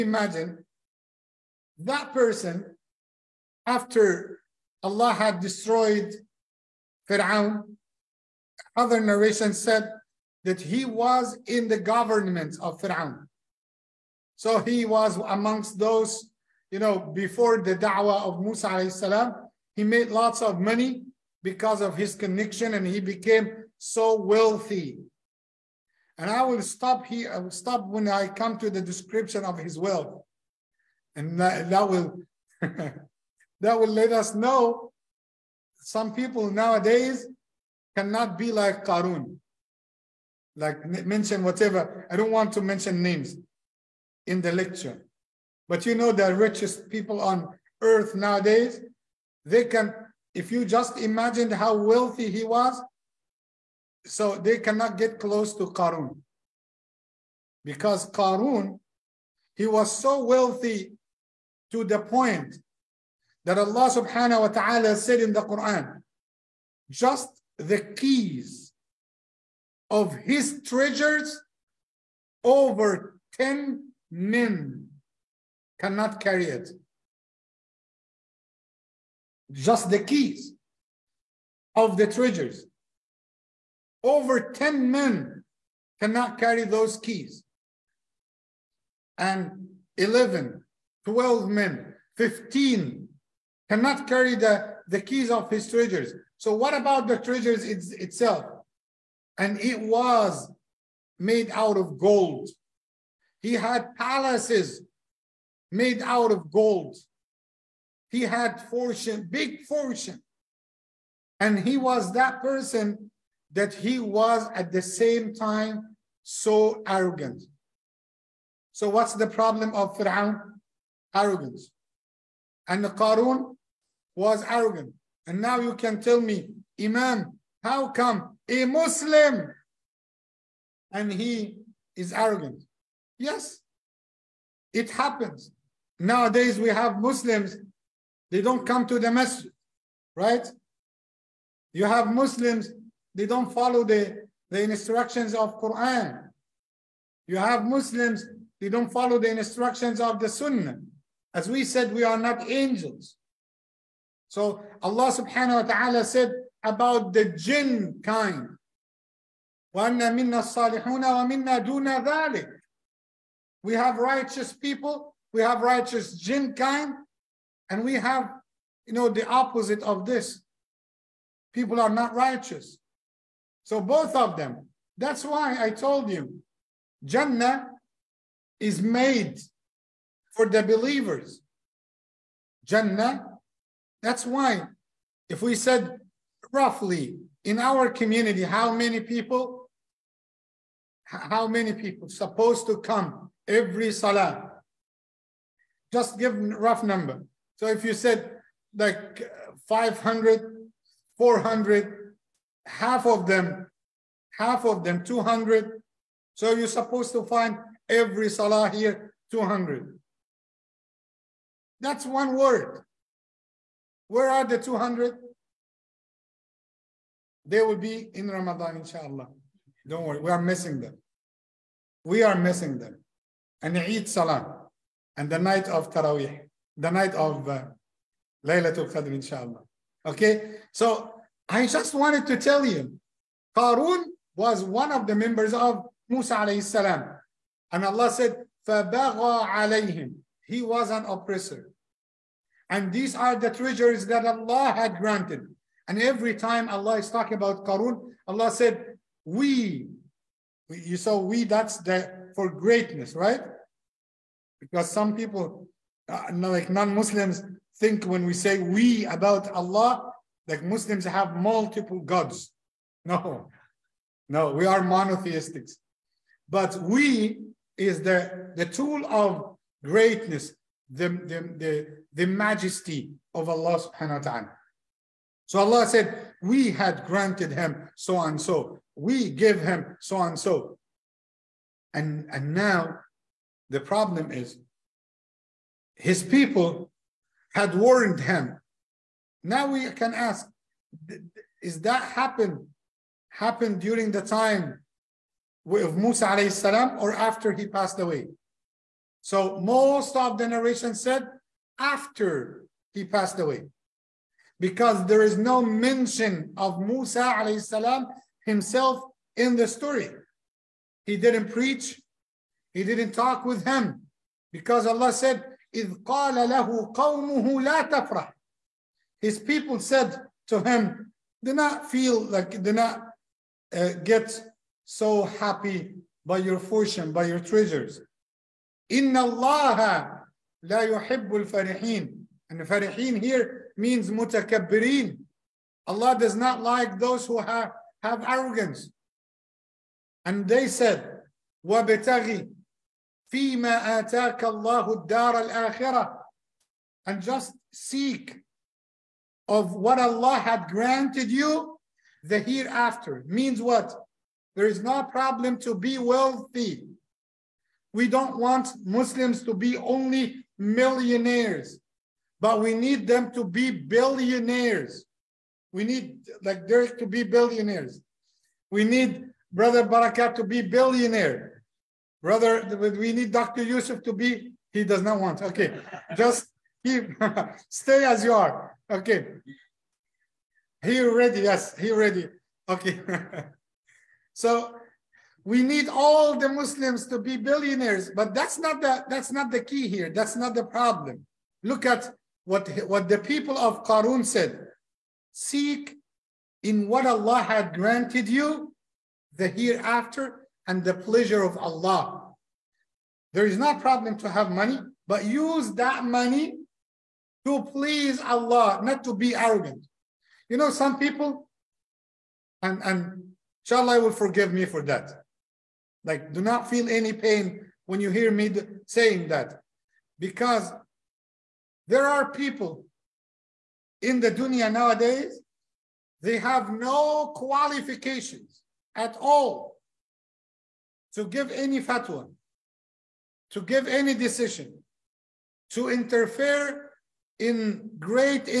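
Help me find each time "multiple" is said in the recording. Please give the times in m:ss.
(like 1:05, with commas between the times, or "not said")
4:21.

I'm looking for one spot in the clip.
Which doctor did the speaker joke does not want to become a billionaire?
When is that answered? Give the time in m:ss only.
6:13.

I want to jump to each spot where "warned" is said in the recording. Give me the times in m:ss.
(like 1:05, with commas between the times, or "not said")
4:47.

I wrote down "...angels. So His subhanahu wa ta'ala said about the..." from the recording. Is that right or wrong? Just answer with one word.
wrong.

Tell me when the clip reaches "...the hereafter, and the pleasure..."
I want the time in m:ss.
6:39.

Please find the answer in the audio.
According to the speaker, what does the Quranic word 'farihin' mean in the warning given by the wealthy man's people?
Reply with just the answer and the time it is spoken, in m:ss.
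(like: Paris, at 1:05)
Mutakabbirin, at 5:34.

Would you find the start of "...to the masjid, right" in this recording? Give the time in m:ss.
2:18.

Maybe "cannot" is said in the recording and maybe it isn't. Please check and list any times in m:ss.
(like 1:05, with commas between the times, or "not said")
0:37, 0:54, 1:15, 1:25, 1:33.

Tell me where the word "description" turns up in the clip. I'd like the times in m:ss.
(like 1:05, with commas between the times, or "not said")
0:28.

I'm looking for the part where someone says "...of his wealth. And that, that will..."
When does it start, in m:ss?
0:29.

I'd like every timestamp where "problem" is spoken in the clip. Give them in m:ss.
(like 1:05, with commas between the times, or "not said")
1:59, 4:43, 5:55, 6:30, 6:43.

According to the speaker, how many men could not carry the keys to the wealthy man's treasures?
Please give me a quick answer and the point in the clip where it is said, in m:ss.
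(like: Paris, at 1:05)
10, at 1:12.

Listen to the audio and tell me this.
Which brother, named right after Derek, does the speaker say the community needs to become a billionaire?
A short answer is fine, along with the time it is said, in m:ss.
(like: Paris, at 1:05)
Barakat, at 6:09.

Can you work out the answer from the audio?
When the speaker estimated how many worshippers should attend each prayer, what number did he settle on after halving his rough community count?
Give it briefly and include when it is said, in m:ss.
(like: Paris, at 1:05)
200, at 3:24.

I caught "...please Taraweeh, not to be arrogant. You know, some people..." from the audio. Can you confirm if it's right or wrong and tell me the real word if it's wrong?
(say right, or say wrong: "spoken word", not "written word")
wrong: "Allah", not "Taraweeh".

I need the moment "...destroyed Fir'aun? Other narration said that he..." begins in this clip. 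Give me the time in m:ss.
0:05.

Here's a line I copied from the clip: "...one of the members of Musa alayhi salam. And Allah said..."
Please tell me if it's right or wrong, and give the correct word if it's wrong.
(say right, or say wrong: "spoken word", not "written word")
right.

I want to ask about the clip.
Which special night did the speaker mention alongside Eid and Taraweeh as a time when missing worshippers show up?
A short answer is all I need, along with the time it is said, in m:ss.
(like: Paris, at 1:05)
Laylatul Qadr, at 3:48.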